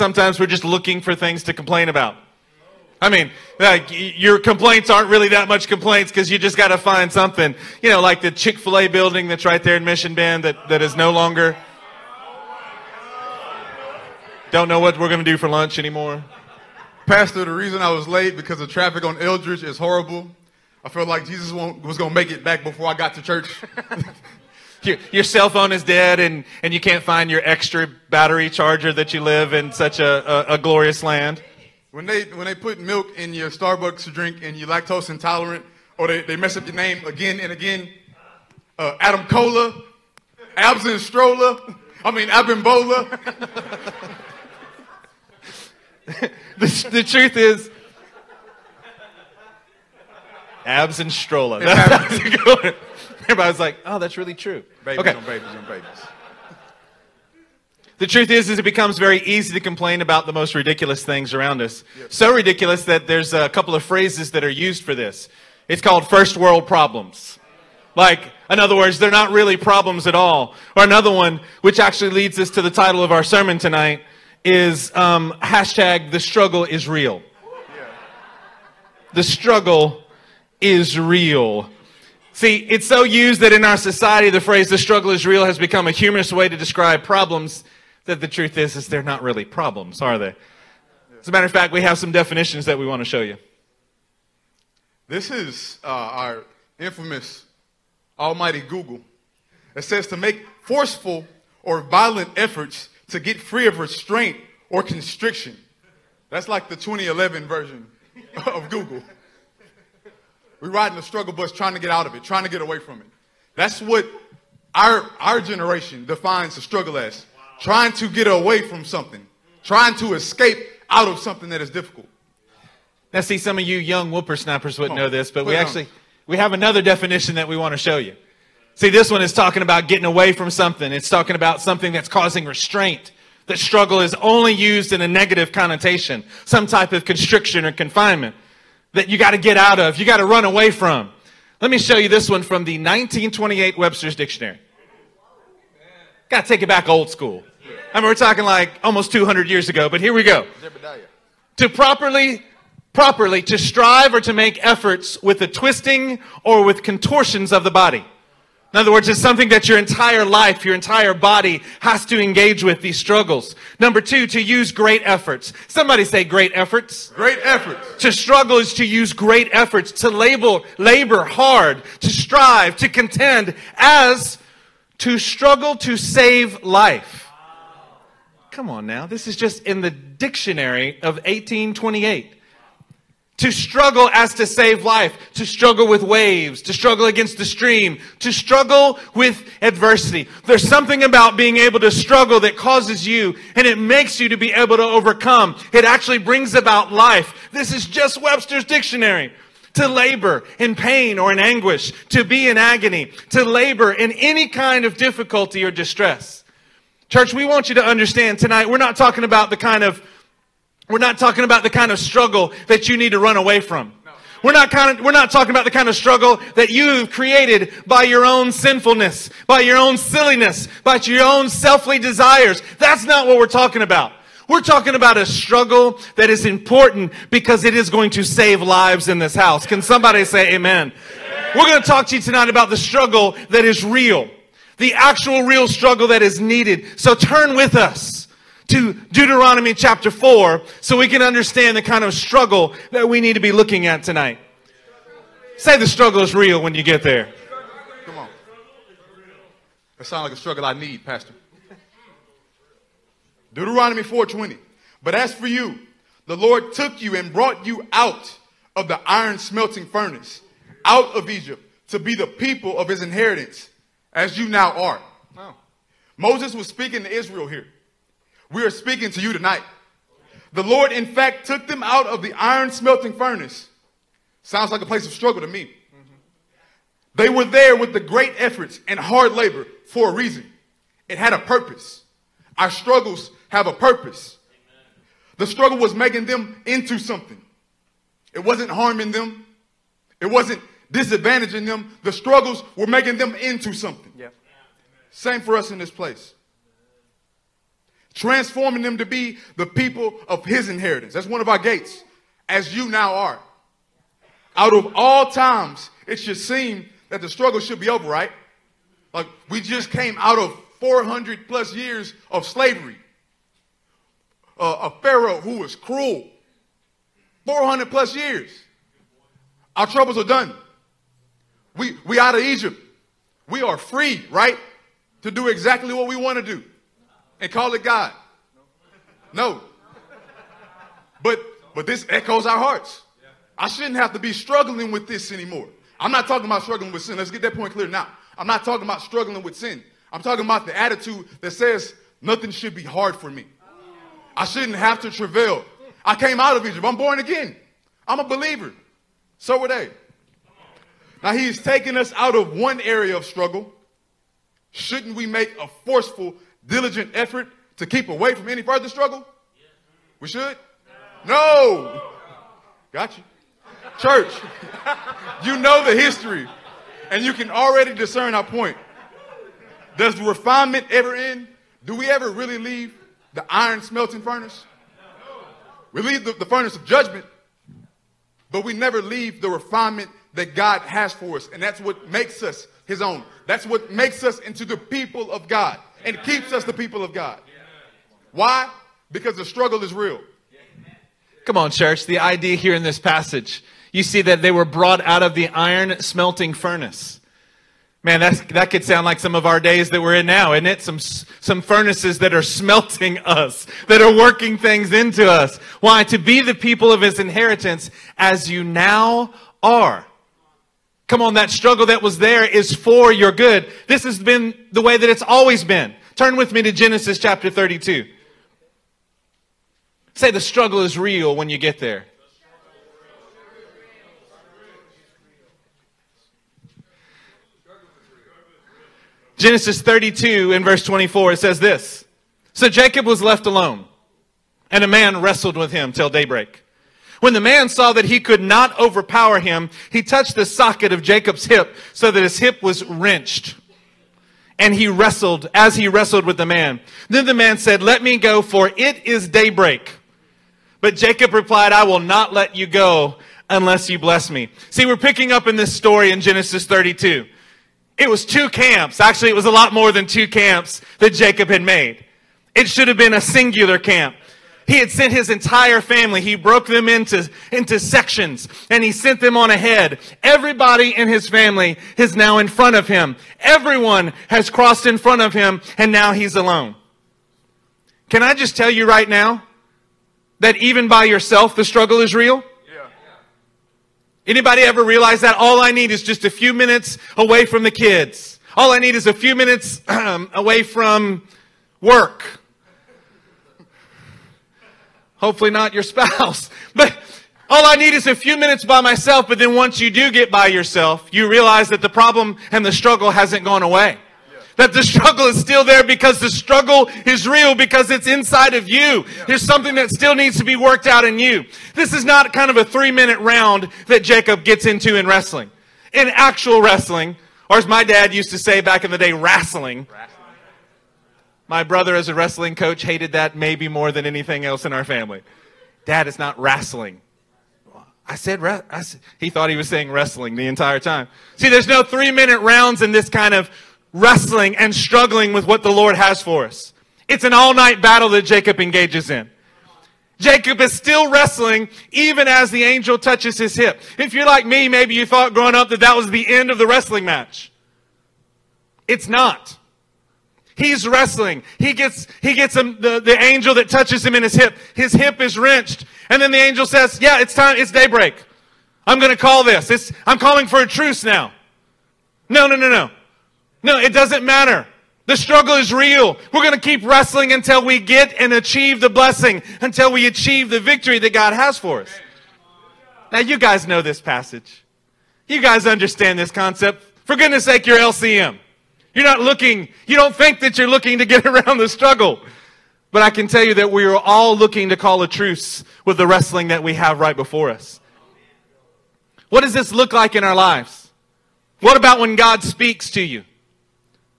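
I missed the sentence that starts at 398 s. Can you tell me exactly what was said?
Man, that's, that could sound like some of our days that we're in now, isn't it?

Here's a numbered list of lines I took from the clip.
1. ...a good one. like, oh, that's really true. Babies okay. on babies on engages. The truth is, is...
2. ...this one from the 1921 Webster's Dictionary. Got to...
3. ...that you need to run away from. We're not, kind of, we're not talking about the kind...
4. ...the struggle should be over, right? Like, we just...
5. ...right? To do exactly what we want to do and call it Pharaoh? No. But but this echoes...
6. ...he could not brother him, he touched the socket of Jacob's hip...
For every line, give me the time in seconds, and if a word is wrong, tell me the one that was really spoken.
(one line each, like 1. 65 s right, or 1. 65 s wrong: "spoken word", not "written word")
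1. 52 s wrong: "babies", not "engages"
2. 142 s wrong: "1928", not "1921"
3. 212 s right
4. 307 s right
5. 324 s wrong: "God", not "Pharaoh"
6. 438 s wrong: "overpower", not "brother".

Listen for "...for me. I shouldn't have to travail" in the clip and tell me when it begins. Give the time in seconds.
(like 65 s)
343 s.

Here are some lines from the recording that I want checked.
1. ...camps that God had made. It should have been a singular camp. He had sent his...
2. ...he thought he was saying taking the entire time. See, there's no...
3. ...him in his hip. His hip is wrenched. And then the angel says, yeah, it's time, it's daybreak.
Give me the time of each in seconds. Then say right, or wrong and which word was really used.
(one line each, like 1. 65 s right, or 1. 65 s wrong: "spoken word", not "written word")
1. 460 s wrong: "Jacob", not "God"
2. 529 s wrong: "wrestling", not "taking"
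3. 554 s right.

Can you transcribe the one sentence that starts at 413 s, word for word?
This has been the way that it's always been.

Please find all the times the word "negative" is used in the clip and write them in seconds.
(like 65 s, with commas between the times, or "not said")
135 s.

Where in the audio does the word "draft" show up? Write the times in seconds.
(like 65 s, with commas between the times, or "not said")
not said.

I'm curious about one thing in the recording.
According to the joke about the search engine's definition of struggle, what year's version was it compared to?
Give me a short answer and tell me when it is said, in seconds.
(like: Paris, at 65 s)
2011, at 106 s.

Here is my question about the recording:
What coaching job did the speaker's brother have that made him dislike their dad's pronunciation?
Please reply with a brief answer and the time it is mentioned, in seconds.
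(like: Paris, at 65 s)
wrestling coach, at 522 s.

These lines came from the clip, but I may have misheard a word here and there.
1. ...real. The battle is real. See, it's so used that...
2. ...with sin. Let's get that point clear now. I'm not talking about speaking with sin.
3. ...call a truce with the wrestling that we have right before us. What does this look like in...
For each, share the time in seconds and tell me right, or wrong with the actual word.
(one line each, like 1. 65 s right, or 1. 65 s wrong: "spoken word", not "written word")
1. 76 s wrong: "struggle", not "battle"
2. 336 s wrong: "struggling", not "speaking"
3. 584 s right.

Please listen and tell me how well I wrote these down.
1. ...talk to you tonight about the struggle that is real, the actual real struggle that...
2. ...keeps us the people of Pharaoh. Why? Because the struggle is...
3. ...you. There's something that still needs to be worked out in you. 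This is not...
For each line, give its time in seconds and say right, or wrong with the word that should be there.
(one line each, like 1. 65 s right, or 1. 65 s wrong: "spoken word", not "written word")
1. 231 s right
2. 386 s wrong: "God", not "Pharaoh"
3. 508 s right.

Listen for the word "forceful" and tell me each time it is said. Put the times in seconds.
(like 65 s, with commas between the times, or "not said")
100 s, 355 s.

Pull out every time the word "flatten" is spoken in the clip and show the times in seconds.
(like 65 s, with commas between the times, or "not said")
not said.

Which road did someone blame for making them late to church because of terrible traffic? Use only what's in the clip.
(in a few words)
Eldridge.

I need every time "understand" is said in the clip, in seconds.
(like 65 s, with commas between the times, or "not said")
207 s, 241 s, 575 s.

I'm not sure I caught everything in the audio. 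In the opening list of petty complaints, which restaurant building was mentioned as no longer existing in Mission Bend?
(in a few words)
Chick Fil A.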